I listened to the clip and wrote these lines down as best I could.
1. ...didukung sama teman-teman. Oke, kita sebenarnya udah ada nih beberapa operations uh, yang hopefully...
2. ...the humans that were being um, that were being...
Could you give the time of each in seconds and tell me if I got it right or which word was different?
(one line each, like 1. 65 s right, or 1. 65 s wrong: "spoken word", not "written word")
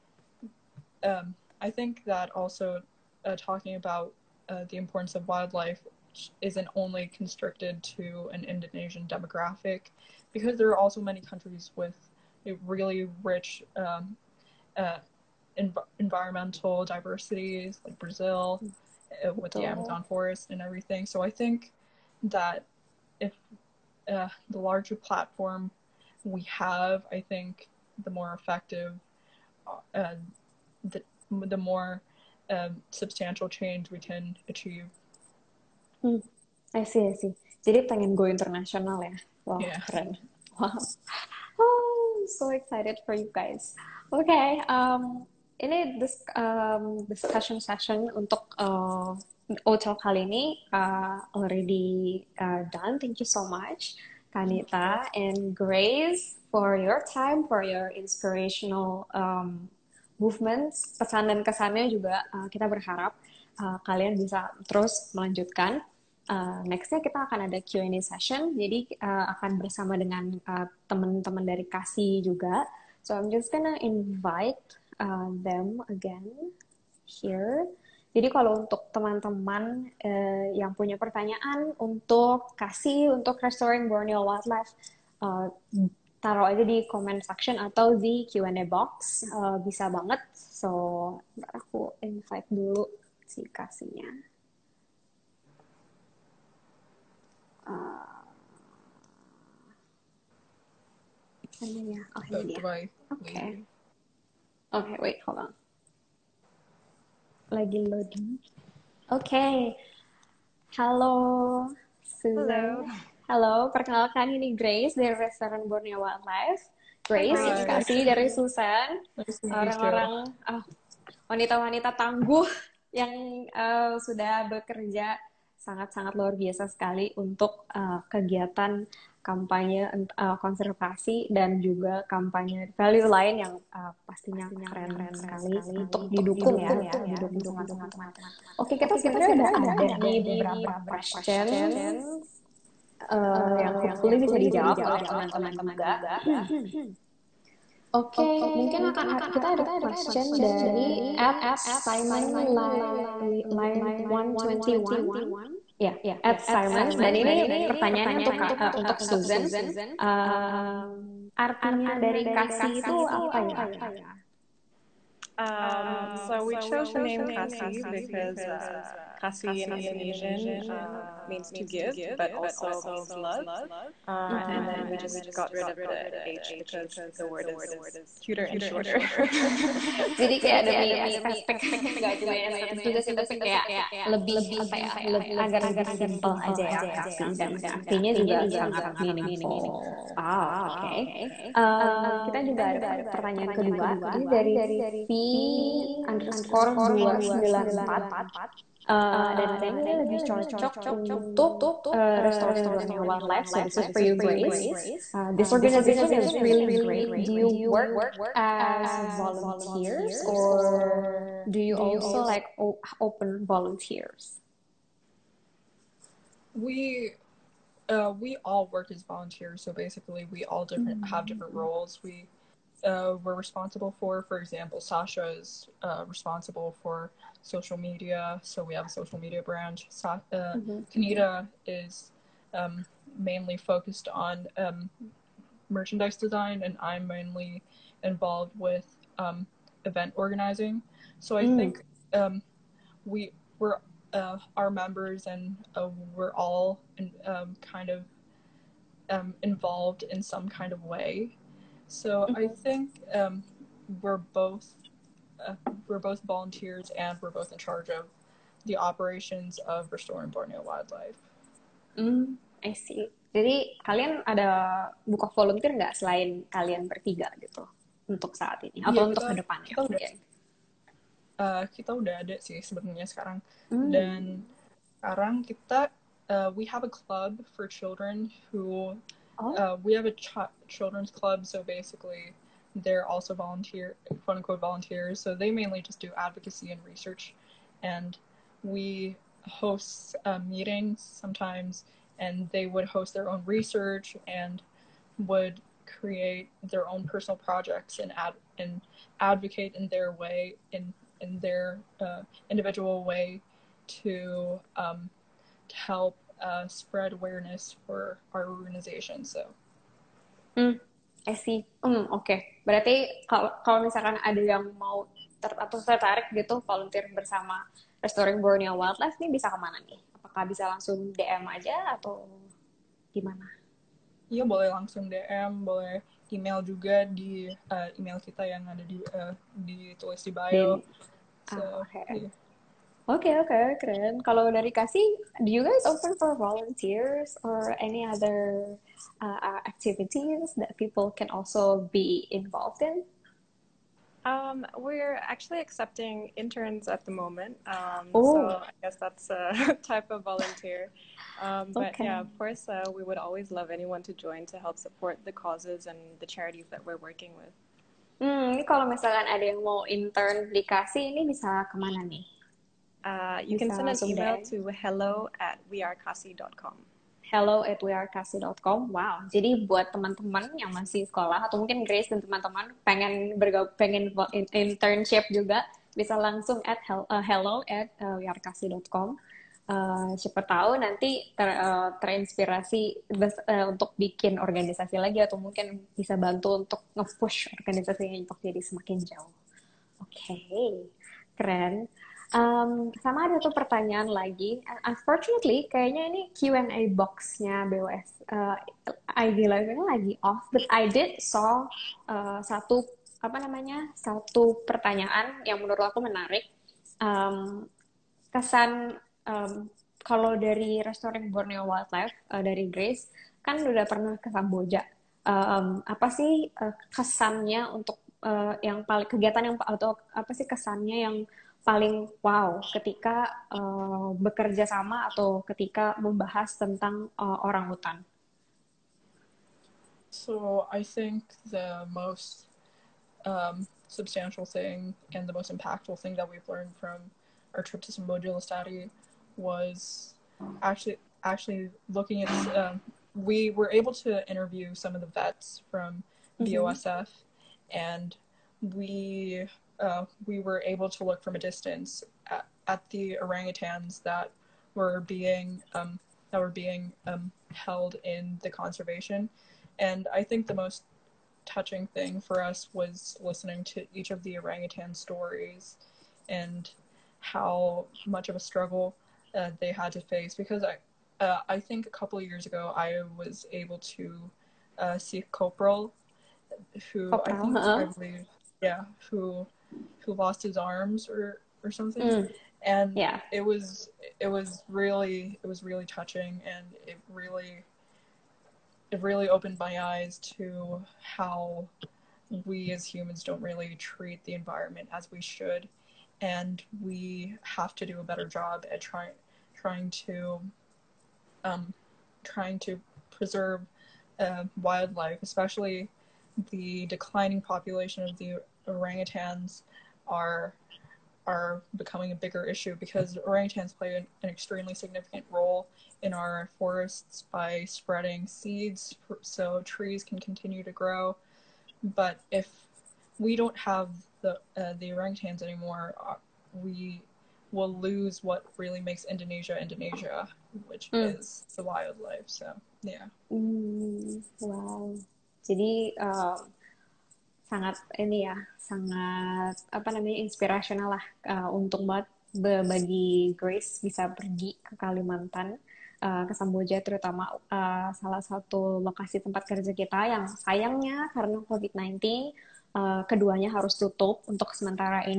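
1. 137 s wrong: "questions", not "operations"
2. 452 s wrong: "orangutans", not "humans".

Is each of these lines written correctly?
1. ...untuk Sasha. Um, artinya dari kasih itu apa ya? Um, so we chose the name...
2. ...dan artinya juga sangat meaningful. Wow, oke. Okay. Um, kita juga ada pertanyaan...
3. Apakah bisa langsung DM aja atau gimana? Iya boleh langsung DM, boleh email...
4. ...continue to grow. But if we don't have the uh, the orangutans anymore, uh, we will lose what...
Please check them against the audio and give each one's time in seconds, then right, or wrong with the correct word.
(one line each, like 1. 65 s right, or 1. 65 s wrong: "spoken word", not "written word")
1. 158 s wrong: "Susan", not "Sasha"
2. 187 s right
3. 320 s right
4. 520 s right.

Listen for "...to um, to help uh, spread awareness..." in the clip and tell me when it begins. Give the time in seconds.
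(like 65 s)
304 s.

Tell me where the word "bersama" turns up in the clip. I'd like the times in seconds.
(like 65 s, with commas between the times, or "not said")
69 s, 317 s.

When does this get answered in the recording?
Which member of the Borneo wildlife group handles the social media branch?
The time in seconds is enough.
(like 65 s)
224 s.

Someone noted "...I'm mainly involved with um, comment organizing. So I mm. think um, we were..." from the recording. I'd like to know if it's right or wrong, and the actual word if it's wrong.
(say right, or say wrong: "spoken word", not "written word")
wrong: "event", not "comment".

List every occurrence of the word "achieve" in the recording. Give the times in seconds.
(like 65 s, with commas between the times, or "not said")
34 s.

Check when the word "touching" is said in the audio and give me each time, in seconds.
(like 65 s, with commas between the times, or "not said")
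461 s, 485 s.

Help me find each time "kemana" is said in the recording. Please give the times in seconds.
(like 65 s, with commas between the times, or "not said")
319 s, 361 s.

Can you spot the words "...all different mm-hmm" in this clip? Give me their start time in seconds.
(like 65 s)
220 s.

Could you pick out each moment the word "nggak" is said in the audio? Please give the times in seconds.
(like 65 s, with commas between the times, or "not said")
182 s, 265 s.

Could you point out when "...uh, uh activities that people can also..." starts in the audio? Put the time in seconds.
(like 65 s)
339 s.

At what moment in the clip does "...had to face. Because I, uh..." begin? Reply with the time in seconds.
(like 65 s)
469 s.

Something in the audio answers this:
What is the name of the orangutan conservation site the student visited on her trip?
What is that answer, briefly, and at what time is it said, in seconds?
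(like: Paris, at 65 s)
Samboja Lestari, at 437 s.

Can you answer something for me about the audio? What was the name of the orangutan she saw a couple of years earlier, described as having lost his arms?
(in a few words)
Copral.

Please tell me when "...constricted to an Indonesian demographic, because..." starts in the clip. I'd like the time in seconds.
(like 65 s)
7 s.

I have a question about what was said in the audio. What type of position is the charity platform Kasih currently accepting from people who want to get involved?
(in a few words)
Interns.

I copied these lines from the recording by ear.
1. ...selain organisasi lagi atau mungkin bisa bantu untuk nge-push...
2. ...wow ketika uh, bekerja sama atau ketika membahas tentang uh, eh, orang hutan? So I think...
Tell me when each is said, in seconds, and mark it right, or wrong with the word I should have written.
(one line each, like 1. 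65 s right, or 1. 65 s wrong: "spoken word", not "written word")
1. 383 s wrong: "bikin", not "selain"
2. 422 s right.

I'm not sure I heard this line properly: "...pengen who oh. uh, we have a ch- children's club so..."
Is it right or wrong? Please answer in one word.
wrong.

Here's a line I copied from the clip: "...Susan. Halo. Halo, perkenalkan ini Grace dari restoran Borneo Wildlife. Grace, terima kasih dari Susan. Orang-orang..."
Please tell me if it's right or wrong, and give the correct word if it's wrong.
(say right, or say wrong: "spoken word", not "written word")
right.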